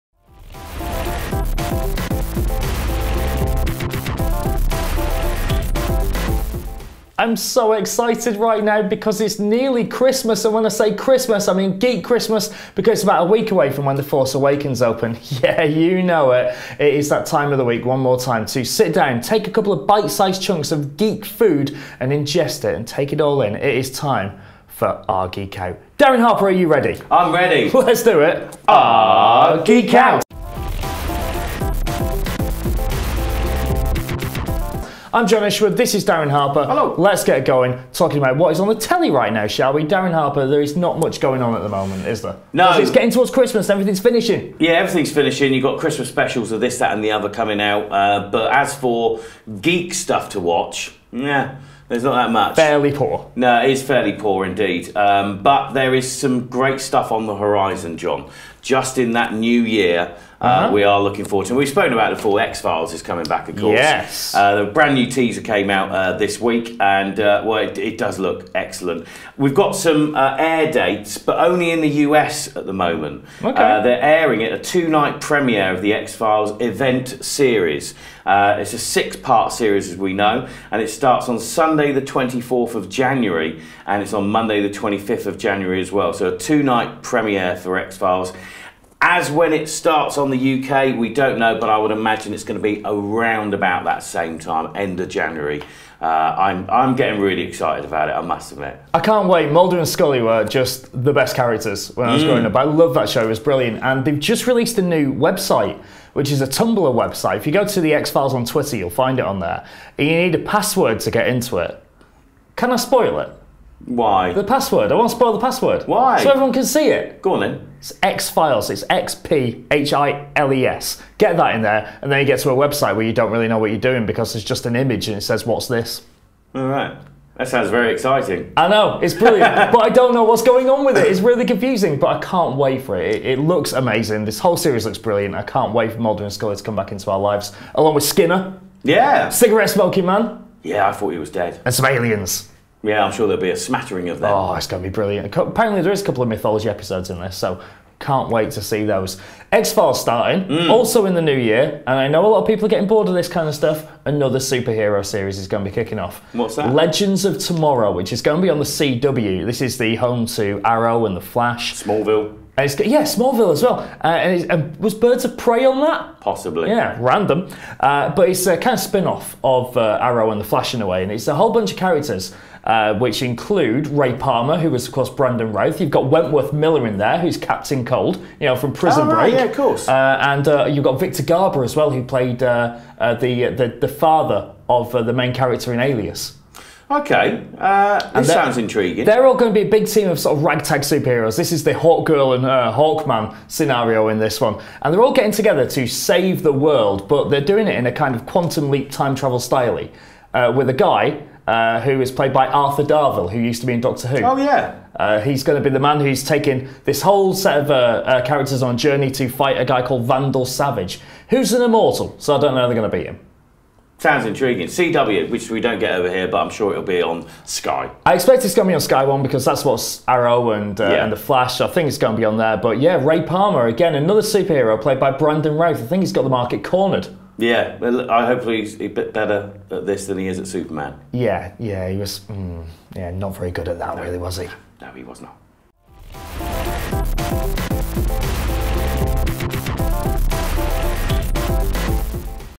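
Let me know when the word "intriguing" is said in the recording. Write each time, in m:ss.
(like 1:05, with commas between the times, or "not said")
3:08, 3:34.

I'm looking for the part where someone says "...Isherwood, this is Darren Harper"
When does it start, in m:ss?
0:35.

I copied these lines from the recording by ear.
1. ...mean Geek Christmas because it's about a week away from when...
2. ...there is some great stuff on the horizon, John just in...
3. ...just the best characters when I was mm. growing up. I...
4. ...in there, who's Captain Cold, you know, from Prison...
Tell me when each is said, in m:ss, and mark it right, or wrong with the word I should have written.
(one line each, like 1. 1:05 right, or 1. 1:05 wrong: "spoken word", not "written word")
1. 0:11 right
2. 0:55 right
3. 1:40 right
4. 2:56 right.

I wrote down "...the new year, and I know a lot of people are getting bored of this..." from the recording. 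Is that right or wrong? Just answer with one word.
right.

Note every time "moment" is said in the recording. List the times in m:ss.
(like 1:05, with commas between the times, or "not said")
0:41, 1:12.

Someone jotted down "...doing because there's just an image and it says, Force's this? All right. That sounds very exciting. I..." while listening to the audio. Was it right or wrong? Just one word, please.
wrong.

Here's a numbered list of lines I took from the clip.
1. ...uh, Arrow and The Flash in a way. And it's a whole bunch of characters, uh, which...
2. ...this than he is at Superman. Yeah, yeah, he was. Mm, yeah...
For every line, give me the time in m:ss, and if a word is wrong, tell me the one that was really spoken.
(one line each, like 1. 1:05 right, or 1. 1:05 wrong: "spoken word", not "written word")
1. 2:49 right
2. 3:49 right.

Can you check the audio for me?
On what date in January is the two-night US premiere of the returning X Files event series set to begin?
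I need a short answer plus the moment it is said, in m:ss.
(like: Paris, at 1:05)
Sunday, 24 January, at 1:21.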